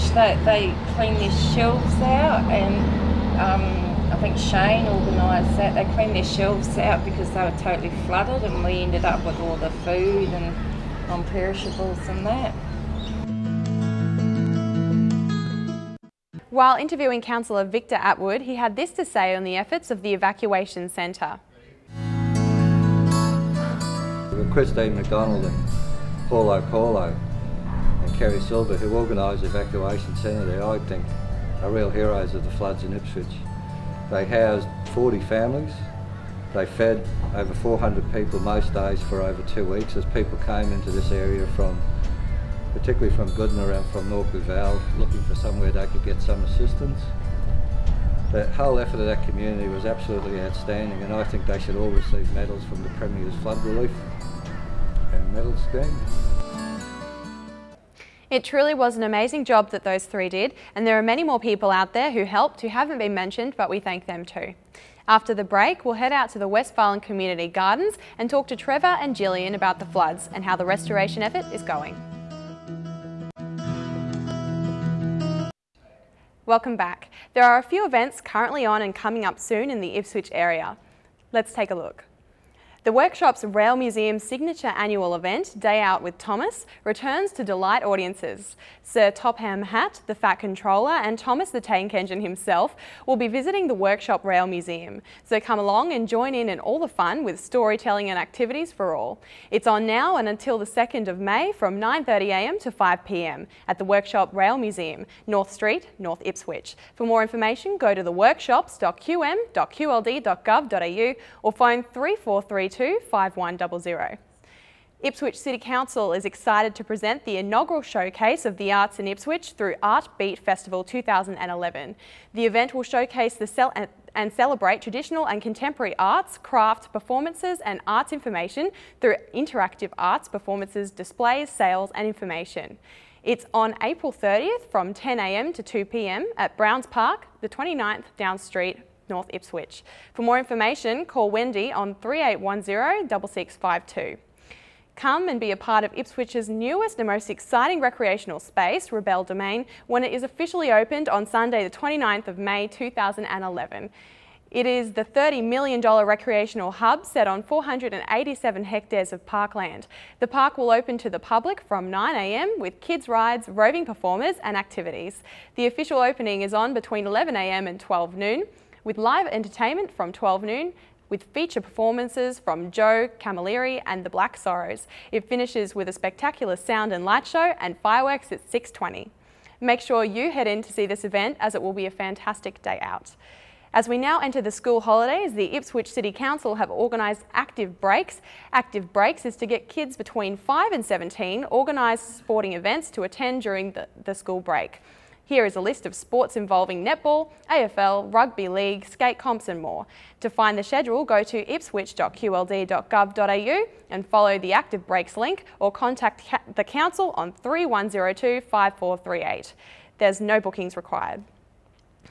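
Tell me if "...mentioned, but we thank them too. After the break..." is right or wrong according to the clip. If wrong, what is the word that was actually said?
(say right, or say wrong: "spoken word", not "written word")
right.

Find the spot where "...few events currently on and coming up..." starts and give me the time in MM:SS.
01:17.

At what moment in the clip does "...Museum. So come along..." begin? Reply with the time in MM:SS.
01:34.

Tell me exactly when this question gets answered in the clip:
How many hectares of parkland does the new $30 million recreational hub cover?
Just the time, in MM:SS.
02:37.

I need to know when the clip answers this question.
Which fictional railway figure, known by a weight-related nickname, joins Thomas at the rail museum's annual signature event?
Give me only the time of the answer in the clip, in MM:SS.
01:28.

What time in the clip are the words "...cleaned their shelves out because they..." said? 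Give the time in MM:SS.
00:05.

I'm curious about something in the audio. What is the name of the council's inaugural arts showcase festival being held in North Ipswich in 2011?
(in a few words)
Art Beat.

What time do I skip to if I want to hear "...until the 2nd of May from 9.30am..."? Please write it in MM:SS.
01:40.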